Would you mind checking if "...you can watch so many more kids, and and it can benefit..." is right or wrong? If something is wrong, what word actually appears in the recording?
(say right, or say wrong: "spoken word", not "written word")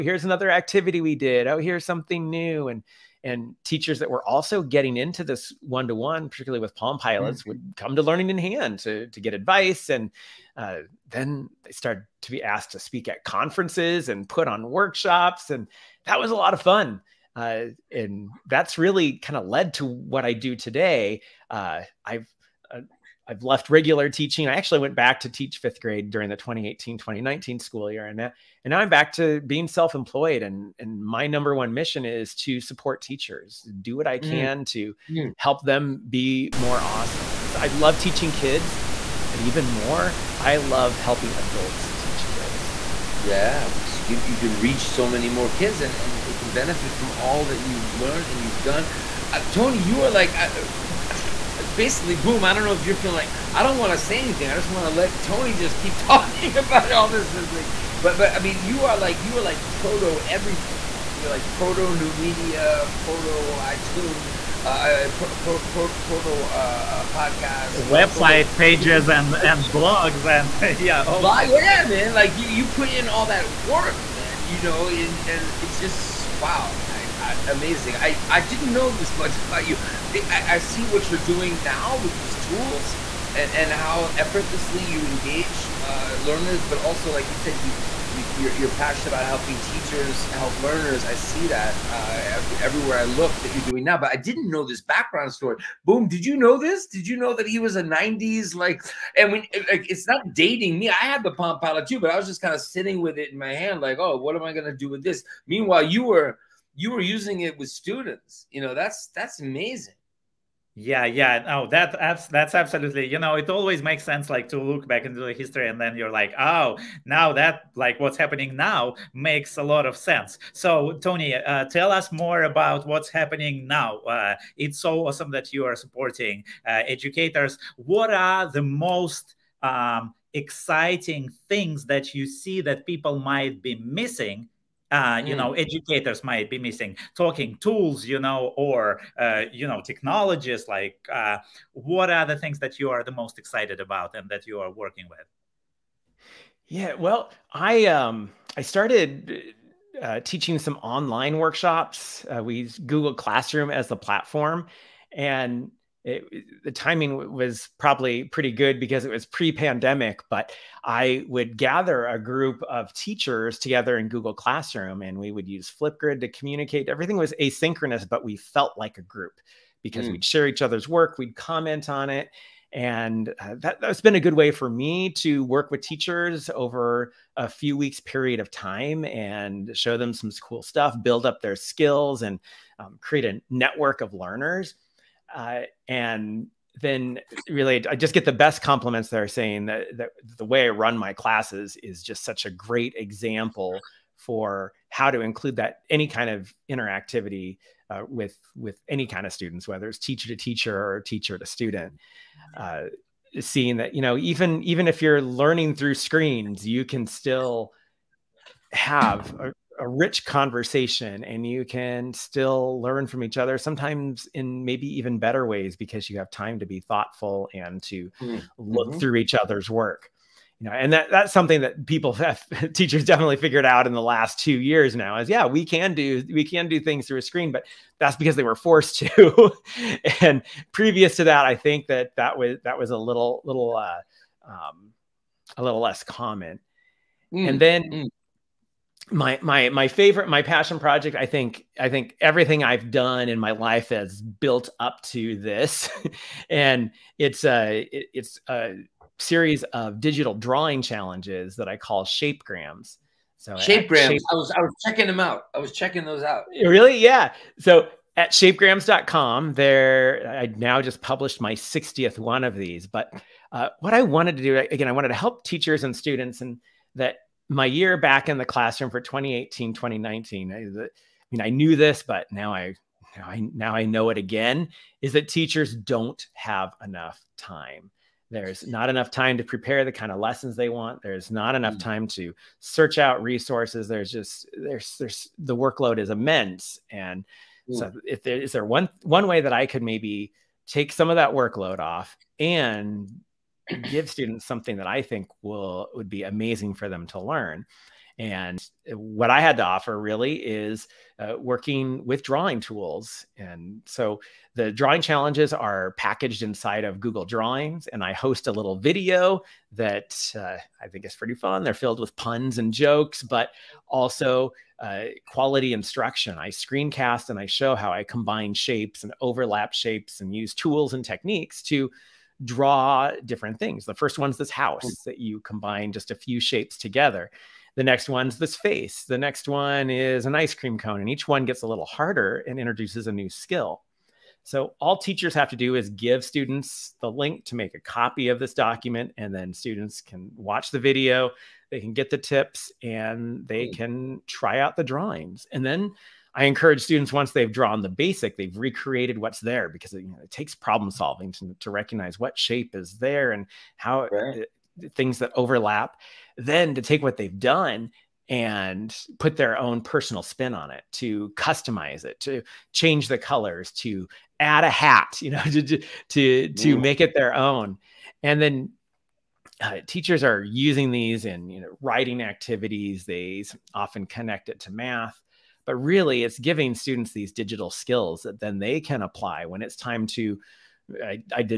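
wrong: "reach", not "watch".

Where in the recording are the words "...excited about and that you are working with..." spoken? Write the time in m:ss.
2:23.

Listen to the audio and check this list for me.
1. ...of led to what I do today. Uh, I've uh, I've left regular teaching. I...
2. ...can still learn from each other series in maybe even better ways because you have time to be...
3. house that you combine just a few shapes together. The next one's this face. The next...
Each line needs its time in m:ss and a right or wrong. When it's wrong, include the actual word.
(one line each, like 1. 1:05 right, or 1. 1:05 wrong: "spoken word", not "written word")
1. 0:19 right
2. 3:31 wrong: "sometimes", not "series"
3. 5:24 right.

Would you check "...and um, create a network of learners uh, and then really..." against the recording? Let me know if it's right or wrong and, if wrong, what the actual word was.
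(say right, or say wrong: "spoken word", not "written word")
right.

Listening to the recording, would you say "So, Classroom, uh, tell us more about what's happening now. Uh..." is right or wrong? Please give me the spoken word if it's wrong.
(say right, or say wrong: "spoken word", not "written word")
wrong: "Tony", not "Classroom".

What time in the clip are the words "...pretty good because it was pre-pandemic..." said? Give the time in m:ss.
2:38.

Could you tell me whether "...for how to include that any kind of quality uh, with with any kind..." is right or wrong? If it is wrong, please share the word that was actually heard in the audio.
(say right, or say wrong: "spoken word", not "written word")
wrong: "interactivity", not "quality".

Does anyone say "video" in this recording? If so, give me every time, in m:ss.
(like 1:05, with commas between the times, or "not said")
5:08, 5:40.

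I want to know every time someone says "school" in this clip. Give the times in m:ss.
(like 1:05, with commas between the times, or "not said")
0:27.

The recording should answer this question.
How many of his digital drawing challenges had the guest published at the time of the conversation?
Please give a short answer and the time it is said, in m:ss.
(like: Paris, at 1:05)
60, at 4:21.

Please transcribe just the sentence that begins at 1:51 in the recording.
No, oh, that abs- that's absolutely.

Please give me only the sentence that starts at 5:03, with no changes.
And so the drawing challenges are packaged inside of Google Drawings.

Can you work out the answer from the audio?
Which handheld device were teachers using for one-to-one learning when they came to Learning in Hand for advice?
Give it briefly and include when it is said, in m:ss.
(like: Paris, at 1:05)
Palm Pilots, at 0:06.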